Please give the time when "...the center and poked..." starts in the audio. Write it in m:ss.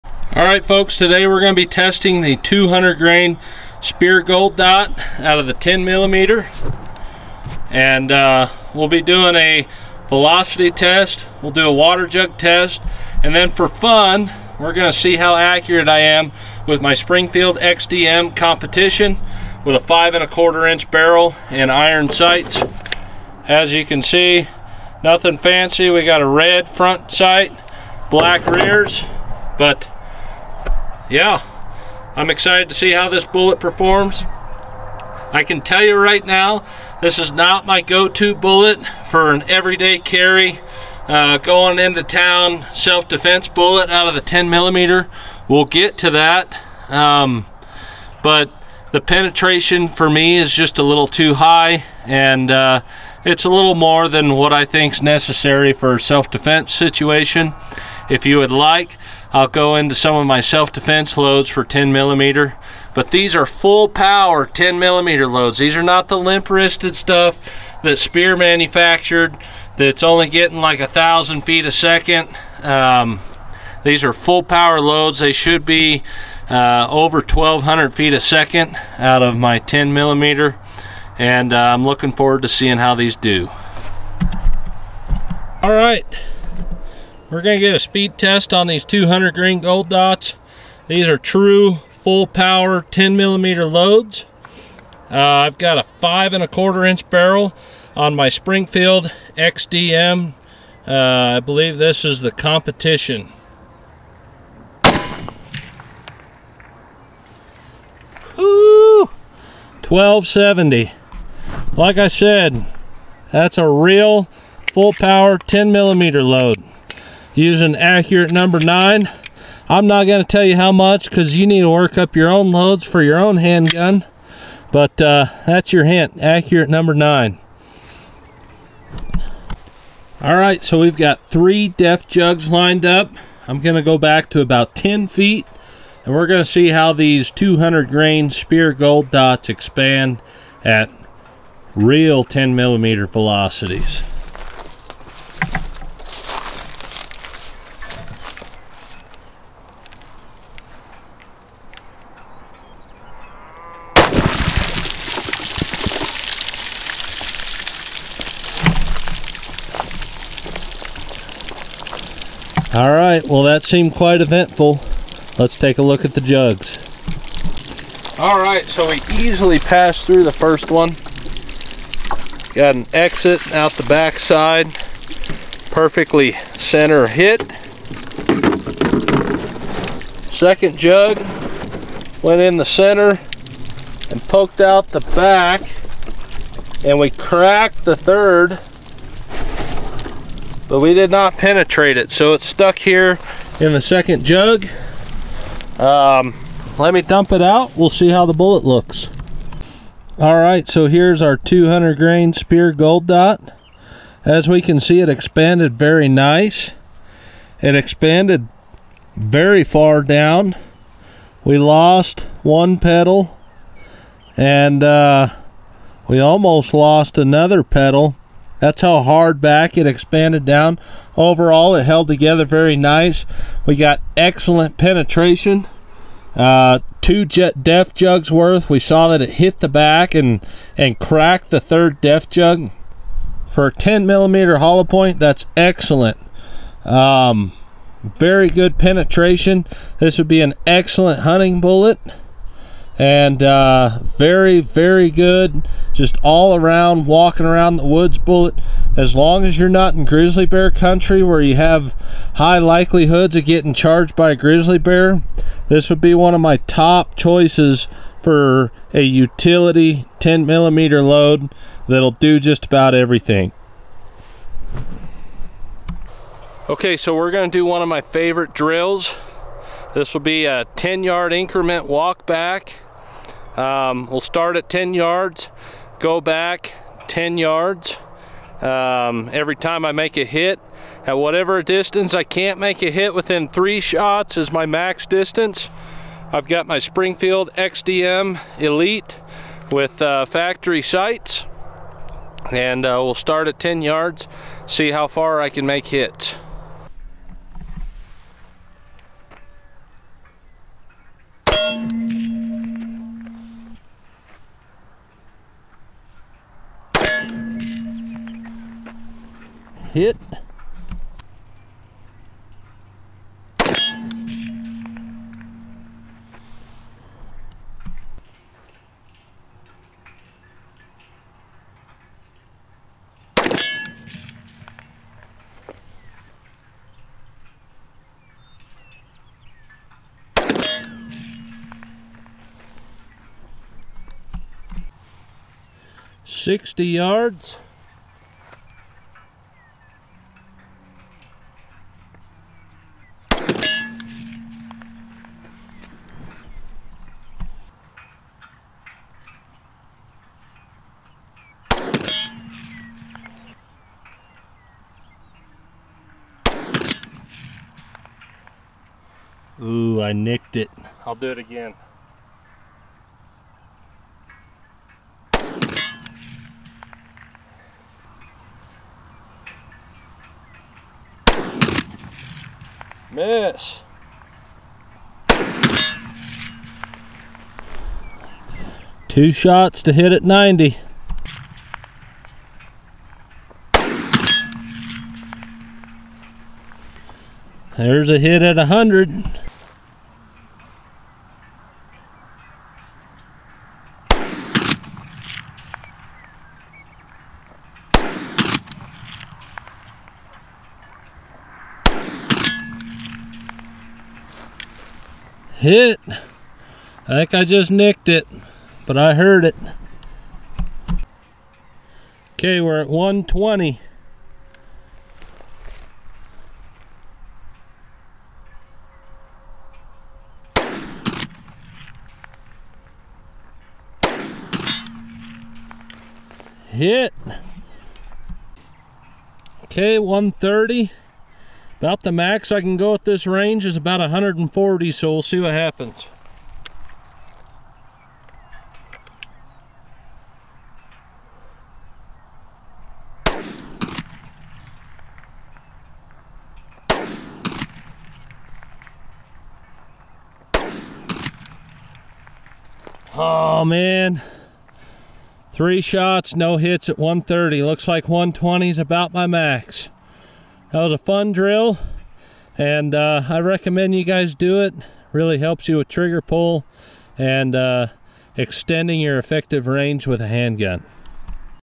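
3:02.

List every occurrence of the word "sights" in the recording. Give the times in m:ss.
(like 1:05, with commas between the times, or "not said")
0:22, 0:27, 4:50.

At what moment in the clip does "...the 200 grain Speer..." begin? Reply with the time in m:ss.
0:02.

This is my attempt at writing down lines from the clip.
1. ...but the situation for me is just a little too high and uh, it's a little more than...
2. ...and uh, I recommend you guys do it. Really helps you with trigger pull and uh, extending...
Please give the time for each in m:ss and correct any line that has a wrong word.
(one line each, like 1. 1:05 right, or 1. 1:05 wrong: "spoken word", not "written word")
1. 0:48 wrong: "penetration", not "situation"
2. 7:42 right.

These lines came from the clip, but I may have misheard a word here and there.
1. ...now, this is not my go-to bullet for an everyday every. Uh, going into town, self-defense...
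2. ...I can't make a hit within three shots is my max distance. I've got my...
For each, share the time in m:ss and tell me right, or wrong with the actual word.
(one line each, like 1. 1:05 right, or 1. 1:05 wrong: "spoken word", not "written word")
1. 0:36 wrong: "carry", not "every"
2. 4:42 right.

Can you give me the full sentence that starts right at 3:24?
As we can see, it expanded very nice.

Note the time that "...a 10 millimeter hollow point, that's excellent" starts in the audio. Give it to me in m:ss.
3:53.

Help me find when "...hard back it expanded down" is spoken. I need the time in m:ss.
3:39.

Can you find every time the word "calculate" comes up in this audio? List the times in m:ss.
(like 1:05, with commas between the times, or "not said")
not said.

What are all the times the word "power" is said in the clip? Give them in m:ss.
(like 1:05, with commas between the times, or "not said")
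1:03, 1:14, 1:32, 1:54.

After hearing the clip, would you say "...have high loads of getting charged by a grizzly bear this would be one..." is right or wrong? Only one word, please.
wrong.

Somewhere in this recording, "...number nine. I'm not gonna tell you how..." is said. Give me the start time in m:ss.
1:58.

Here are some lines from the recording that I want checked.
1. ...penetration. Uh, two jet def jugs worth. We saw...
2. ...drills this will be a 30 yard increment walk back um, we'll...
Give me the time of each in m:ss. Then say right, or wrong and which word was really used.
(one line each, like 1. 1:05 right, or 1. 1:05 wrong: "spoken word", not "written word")
1. 3:44 right
2. 4:28 wrong: "10", not "30".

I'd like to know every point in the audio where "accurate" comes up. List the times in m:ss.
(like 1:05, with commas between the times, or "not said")
0:15, 1:57, 2:06.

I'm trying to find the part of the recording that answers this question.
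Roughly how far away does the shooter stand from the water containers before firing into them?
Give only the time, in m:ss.
2:14.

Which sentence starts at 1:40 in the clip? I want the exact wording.
Uh, I believe this is the competition.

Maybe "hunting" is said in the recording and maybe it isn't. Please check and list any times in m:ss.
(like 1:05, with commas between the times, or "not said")
4:01.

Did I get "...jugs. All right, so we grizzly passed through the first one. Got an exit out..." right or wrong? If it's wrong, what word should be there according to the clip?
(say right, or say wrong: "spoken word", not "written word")
wrong: "easily", not "grizzly".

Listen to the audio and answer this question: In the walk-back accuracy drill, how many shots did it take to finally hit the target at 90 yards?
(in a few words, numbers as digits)
2.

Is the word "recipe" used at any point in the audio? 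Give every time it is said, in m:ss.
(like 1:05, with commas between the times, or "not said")
not said.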